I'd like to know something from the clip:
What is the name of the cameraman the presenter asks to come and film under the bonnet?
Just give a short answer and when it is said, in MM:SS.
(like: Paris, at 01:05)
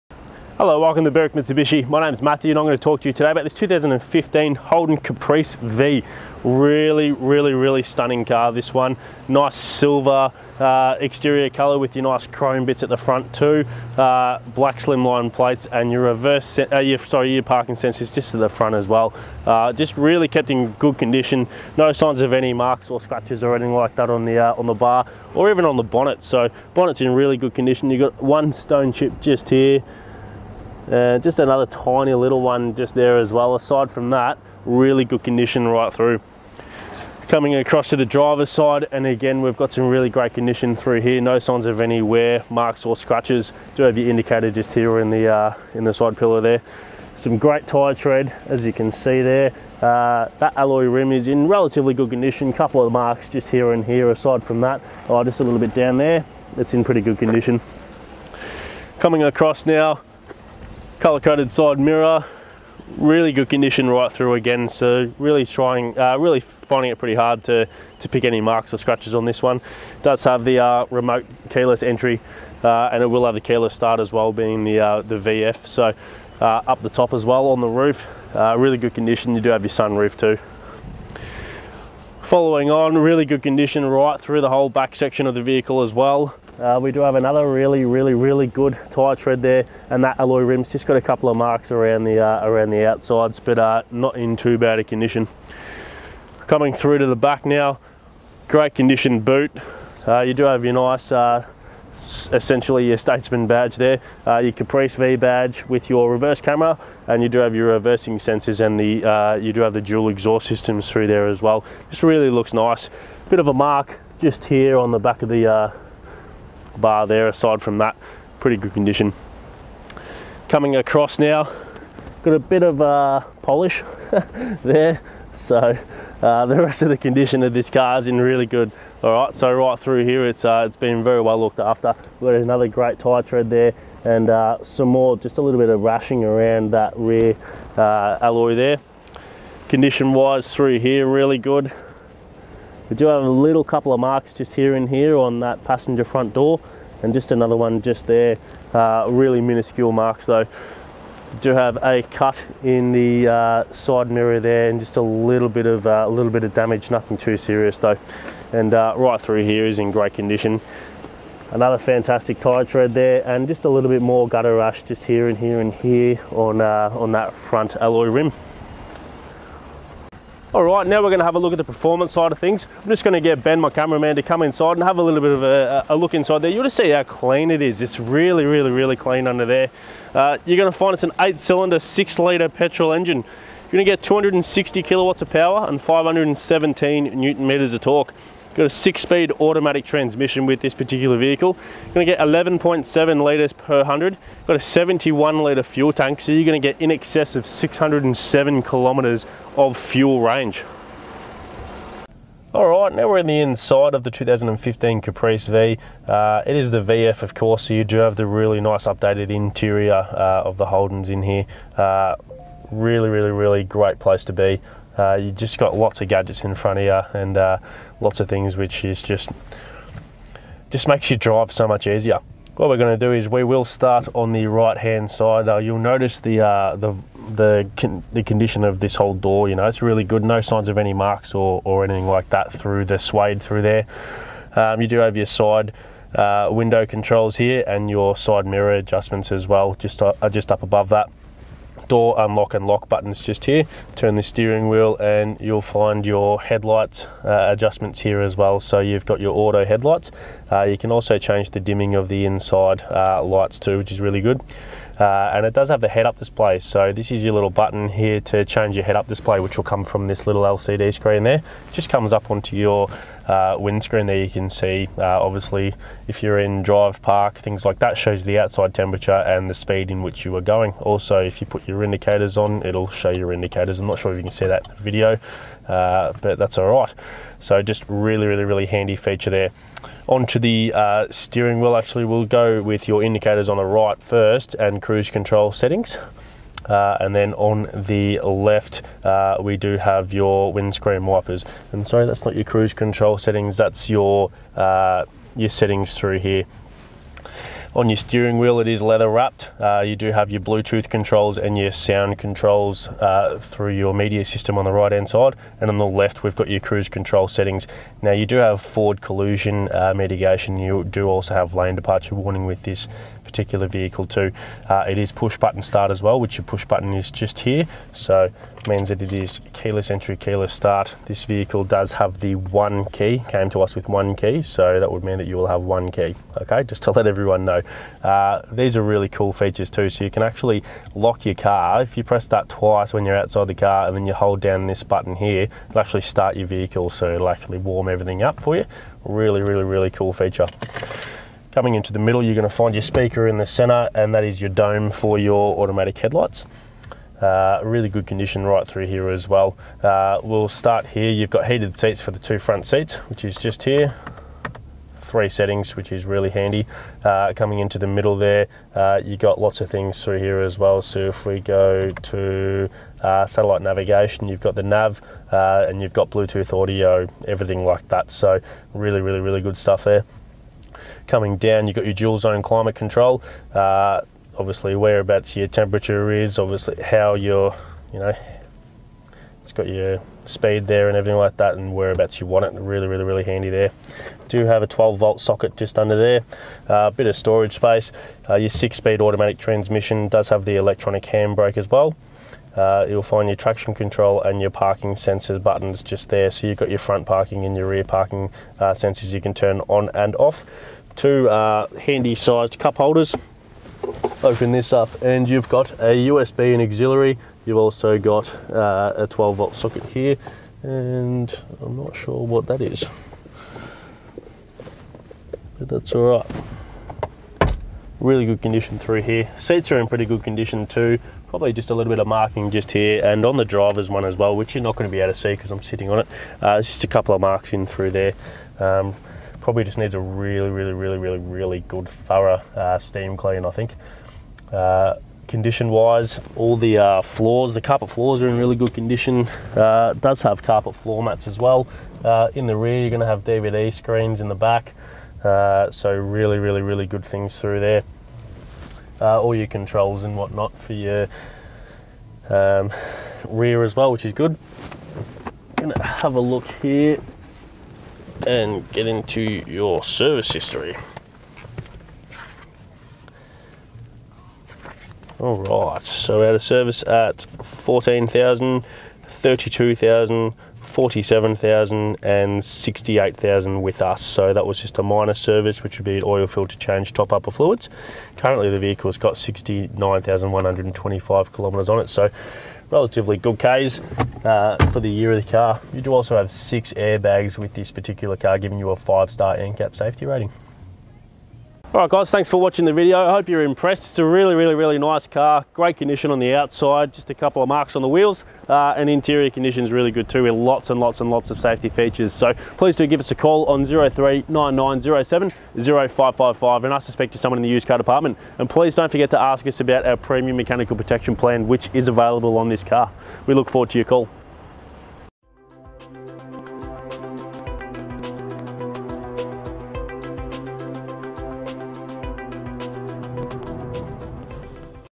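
Ben, at 02:53.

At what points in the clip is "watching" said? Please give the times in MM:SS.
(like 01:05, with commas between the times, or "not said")
08:12.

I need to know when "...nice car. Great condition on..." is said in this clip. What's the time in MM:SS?
08:14.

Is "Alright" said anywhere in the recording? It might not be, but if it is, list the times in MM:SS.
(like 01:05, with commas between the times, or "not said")
08:11.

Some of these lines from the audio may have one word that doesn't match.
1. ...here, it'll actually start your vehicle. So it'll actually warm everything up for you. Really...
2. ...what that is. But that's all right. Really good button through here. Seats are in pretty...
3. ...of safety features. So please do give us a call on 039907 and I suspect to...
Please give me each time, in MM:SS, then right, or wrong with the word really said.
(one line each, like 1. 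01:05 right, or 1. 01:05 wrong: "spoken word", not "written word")
1. 05:35 right
2. 06:52 wrong: "condition", not "button"
3. 08:21 right.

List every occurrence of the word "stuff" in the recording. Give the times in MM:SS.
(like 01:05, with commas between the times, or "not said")
06:09.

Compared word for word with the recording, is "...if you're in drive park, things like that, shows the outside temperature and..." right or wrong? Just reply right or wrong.
right.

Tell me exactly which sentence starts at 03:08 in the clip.
Got a six-speed automatic transmission with this particular vehicle.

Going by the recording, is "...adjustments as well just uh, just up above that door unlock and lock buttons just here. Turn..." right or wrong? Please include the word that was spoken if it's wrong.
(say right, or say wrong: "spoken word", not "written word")
right.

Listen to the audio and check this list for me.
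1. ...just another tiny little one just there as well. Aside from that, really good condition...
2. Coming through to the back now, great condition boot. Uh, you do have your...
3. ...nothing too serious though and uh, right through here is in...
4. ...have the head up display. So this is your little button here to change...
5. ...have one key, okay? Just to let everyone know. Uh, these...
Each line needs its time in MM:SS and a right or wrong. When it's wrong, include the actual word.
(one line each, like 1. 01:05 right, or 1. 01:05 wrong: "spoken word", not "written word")
1. 00:31 right
2. 01:36 right
3. 02:36 right
4. 04:15 right
5. 05:25 right.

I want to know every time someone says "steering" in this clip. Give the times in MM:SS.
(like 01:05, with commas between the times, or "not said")
04:04, 04:41, 04:57.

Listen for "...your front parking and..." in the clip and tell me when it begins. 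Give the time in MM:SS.
06:36.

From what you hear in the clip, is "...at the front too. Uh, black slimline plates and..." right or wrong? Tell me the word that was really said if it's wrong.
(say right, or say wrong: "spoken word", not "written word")
right.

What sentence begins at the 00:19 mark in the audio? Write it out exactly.
Uh, just really kept in good condition.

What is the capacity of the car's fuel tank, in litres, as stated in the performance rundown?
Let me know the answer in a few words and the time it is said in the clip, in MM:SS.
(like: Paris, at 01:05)
71 litres, at 03:14.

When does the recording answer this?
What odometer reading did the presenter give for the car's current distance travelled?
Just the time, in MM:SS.
07:59.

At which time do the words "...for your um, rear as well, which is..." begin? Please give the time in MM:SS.
07:30.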